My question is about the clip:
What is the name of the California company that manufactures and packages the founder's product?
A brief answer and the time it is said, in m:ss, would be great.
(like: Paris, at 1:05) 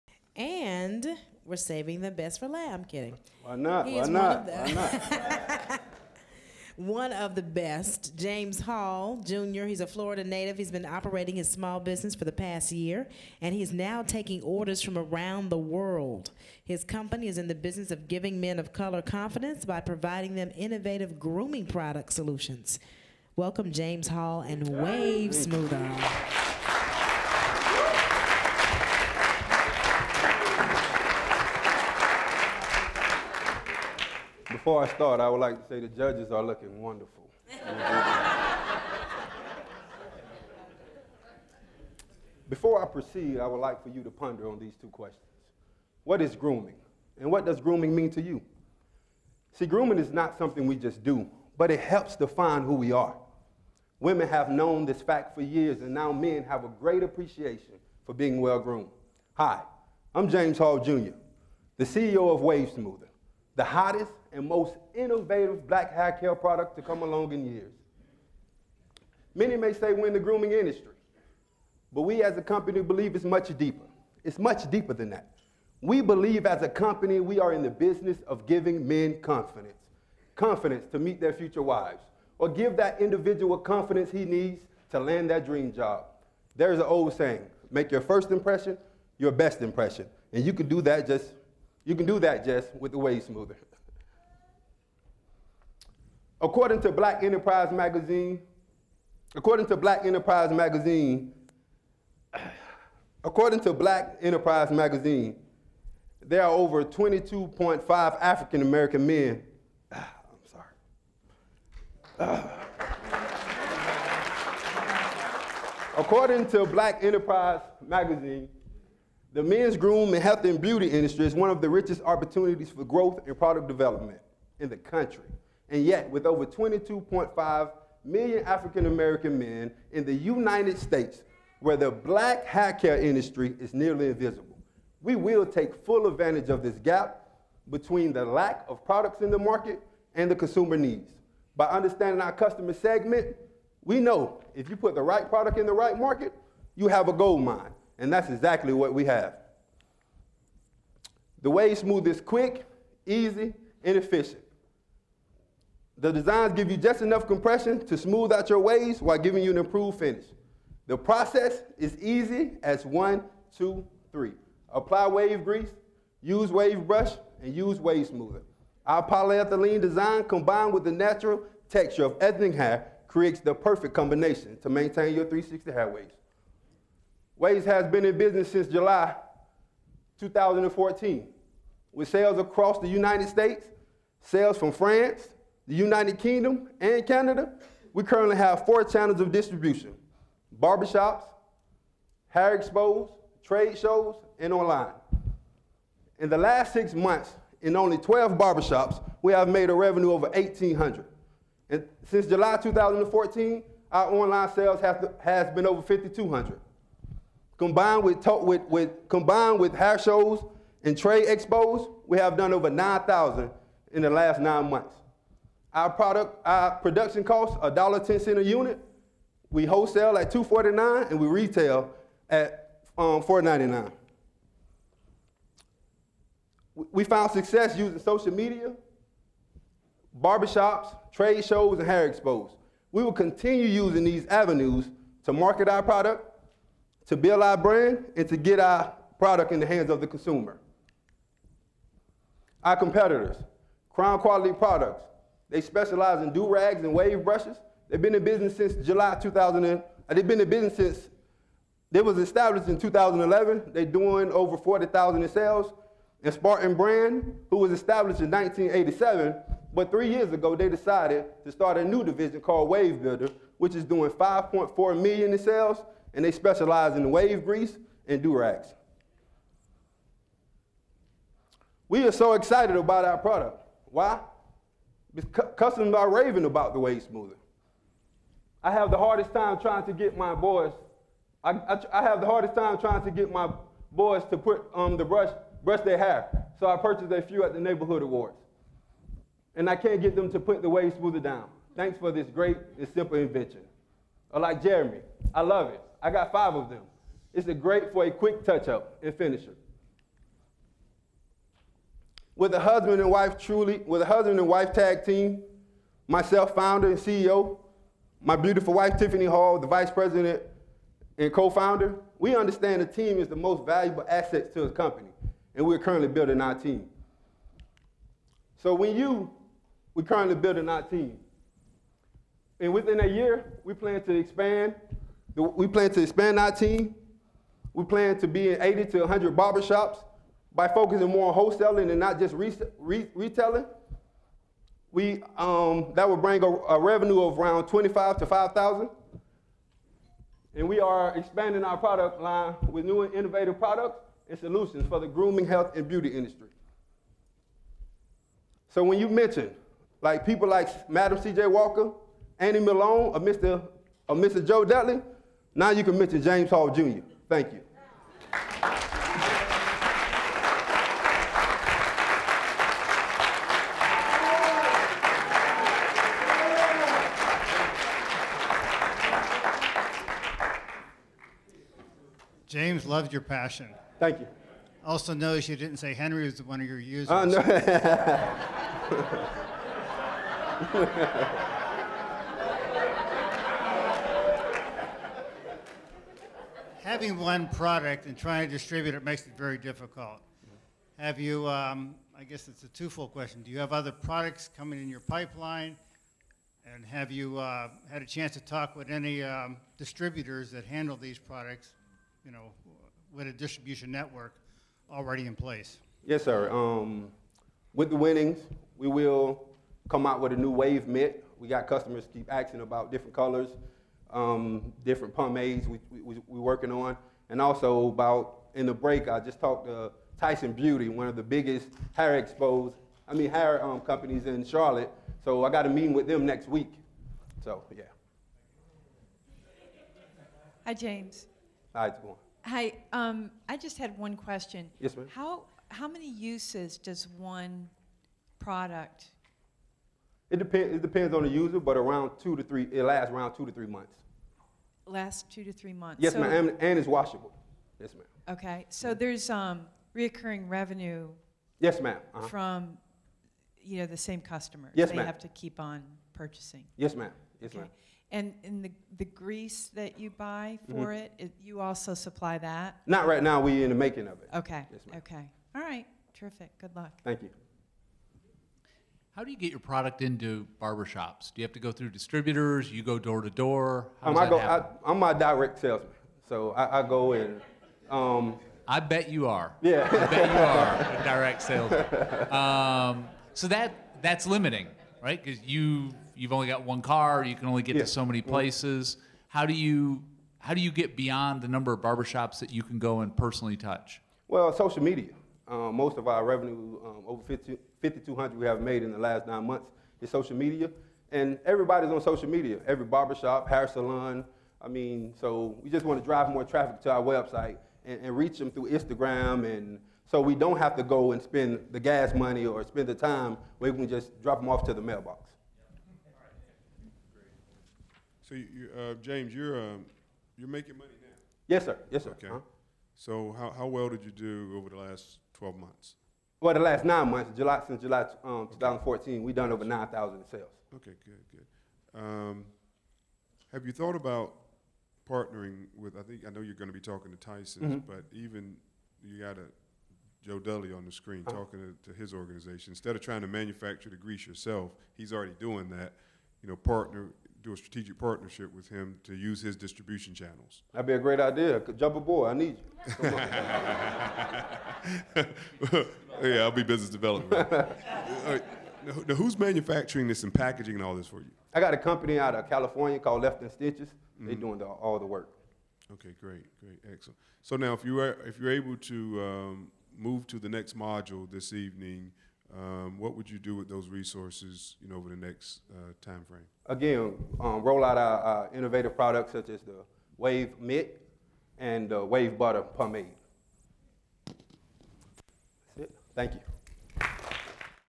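Left and Stitches, at 9:23.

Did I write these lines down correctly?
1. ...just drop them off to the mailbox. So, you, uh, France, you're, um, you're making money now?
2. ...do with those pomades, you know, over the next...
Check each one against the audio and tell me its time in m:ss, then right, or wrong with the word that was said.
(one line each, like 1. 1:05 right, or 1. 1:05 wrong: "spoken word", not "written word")
1. 8:33 wrong: "James", not "France"
2. 9:33 wrong: "resources", not "pomades".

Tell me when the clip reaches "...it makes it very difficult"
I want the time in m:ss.
6:28.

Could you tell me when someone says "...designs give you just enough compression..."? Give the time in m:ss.
2:36.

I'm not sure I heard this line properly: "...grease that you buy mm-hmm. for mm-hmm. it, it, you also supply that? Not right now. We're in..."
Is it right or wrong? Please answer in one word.
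right.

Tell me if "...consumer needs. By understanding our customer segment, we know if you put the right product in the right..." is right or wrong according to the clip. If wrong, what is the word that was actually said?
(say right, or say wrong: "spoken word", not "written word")
right.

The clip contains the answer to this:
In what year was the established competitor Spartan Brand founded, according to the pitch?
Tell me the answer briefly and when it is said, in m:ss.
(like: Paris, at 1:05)
1987, at 4:17.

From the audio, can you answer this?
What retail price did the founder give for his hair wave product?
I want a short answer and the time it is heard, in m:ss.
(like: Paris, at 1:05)
$4.99, at 3:41.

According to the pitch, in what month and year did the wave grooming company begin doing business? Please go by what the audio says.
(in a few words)
July 2014.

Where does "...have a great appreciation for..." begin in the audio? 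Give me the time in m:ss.
0:56.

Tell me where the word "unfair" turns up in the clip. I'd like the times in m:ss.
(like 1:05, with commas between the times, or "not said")
not said.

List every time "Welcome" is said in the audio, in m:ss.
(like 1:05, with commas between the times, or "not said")
0:23.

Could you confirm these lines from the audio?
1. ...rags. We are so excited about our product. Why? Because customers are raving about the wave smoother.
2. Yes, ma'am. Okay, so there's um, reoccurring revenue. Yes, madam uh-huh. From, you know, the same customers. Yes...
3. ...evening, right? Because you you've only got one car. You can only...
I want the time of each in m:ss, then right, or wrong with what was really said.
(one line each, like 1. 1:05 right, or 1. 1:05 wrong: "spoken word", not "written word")
1. 4:28 right
2. 7:27 right
3. 8:04 wrong: "limiting", not "evening".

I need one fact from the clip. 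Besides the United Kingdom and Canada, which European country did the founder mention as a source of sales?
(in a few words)
France.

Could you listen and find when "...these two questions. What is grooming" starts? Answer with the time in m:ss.
0:44.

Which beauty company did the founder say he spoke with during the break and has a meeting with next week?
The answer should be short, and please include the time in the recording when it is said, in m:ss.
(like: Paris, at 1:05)
Tyson Beauty, at 7:00.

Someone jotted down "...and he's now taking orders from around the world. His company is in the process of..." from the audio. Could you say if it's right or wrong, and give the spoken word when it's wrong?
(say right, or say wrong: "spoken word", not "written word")
wrong: "business", not "process".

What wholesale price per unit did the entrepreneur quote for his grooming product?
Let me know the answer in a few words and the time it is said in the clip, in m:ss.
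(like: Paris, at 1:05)
$2.49, at 3:39.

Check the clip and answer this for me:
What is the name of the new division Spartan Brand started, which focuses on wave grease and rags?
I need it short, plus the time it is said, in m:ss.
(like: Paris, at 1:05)
Wave Builder, at 4:22.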